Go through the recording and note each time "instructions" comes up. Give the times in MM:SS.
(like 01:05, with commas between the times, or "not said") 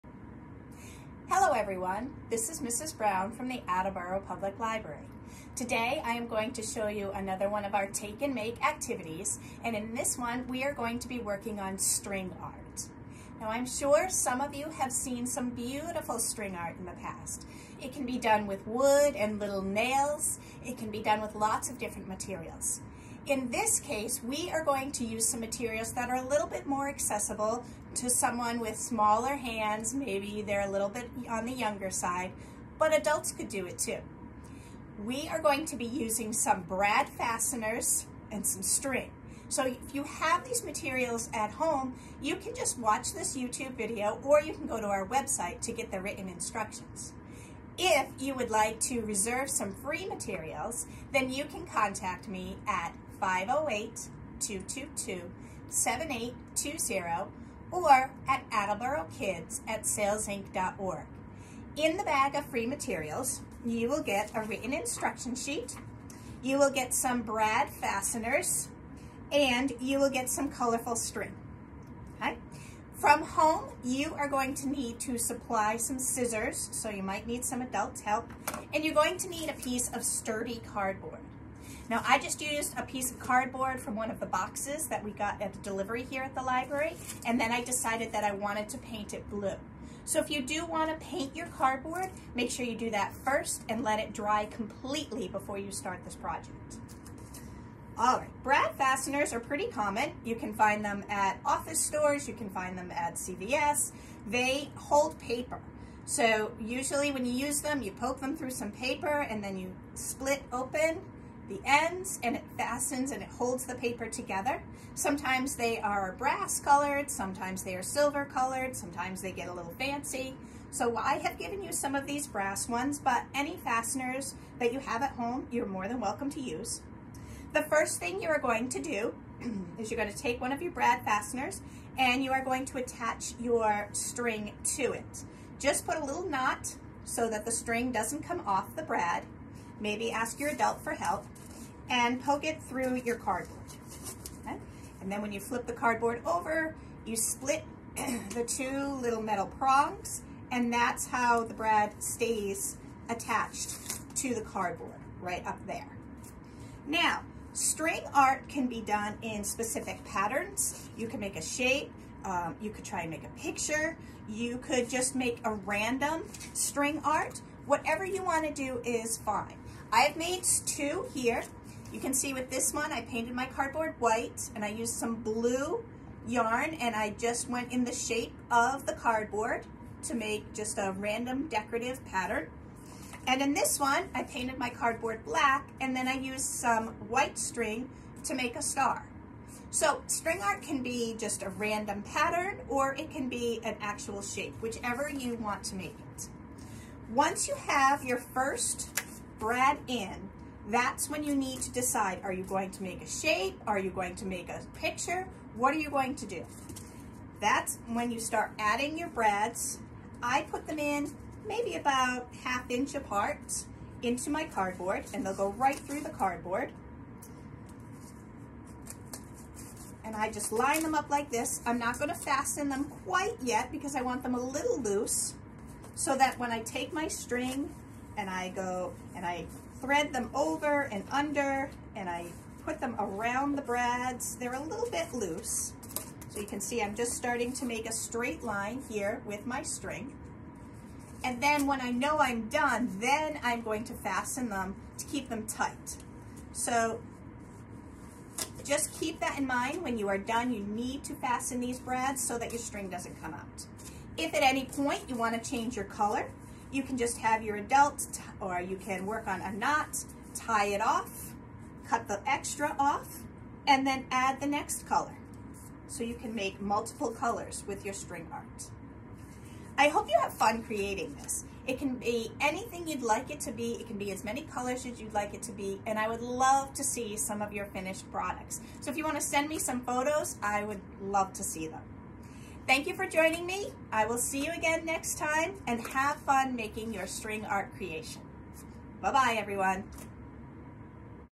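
00:46, 01:04.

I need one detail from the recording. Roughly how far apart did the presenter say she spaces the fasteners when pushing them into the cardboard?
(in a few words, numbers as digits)
Half inch.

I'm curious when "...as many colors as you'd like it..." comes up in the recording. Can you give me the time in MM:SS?
04:34.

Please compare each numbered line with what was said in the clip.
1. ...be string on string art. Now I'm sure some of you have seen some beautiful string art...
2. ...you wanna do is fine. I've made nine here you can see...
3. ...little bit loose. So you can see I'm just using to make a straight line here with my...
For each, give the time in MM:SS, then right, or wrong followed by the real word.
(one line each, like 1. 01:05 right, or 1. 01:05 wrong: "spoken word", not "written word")
1. 00:11 wrong: "working", not "string"
2. 02:48 wrong: "two", not "nine"
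3. 03:54 wrong: "starting", not "using".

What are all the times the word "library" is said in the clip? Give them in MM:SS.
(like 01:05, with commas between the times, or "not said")
00:04, 01:26.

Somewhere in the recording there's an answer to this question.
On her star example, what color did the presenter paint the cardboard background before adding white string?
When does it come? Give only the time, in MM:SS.
03:05.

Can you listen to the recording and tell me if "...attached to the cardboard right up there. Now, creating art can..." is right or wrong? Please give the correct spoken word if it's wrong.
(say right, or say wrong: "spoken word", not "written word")
wrong: "string", not "creating".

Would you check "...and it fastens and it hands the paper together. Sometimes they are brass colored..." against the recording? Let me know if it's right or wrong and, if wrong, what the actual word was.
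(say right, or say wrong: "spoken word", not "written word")
wrong: "holds", not "hands".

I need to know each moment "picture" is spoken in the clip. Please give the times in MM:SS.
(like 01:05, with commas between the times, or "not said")
02:43, 03:24.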